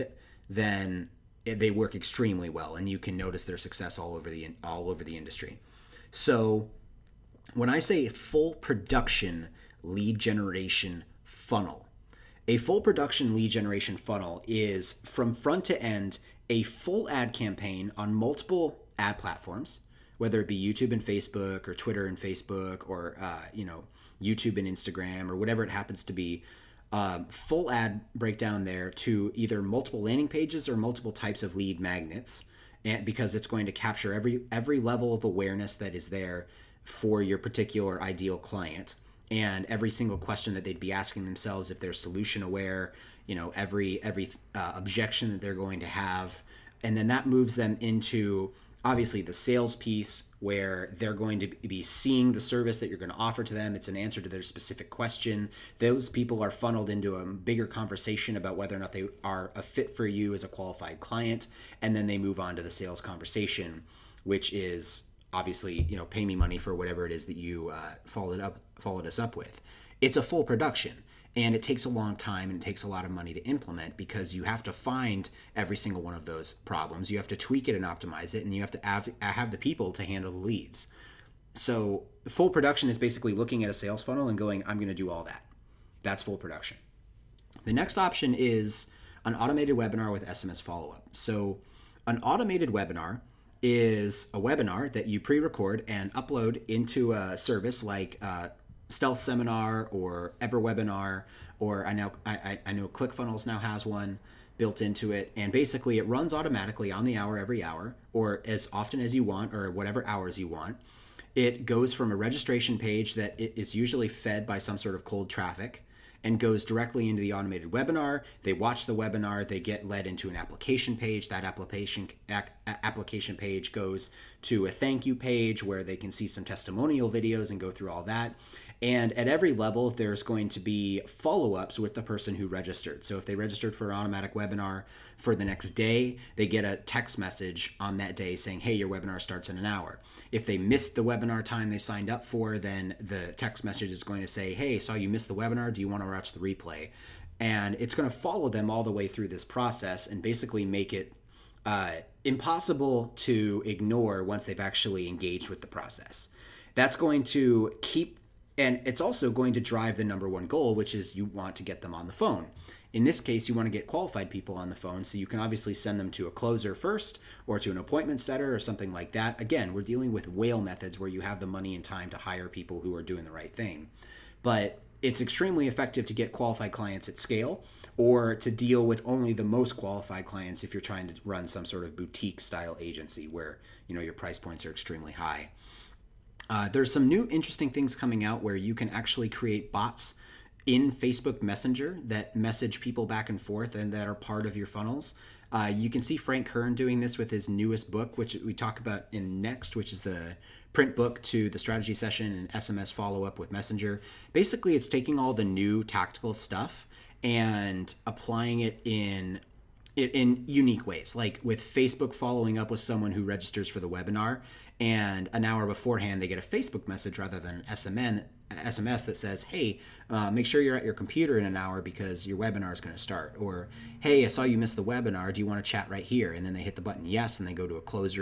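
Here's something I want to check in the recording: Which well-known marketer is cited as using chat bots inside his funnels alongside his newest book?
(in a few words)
Frank Kern.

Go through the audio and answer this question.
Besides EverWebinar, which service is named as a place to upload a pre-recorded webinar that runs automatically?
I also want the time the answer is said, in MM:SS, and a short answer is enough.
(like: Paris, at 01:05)
Stealth Seminar, at 01:38.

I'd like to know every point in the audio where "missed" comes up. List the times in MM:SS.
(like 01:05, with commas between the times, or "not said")
02:20, 02:25, 03:44.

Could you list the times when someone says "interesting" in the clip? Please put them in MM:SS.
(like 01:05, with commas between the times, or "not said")
03:07.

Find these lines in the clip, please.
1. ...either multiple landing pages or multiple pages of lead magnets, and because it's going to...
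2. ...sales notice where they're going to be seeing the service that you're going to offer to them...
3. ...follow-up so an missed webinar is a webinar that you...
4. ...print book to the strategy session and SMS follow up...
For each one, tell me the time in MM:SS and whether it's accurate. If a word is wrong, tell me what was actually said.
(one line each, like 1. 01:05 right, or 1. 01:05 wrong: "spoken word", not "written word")
1. 00:29 wrong: "types", not "pages"
2. 00:49 wrong: "piece", not "notice"
3. 01:30 wrong: "automated", not "missed"
4. 03:20 right.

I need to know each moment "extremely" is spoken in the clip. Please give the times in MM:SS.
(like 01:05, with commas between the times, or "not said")
00:01, 02:55, 03:04.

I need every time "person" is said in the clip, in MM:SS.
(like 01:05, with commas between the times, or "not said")
02:12.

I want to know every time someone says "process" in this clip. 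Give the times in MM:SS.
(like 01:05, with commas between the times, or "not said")
02:29, 02:35.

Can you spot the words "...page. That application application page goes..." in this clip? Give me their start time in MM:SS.
02:00.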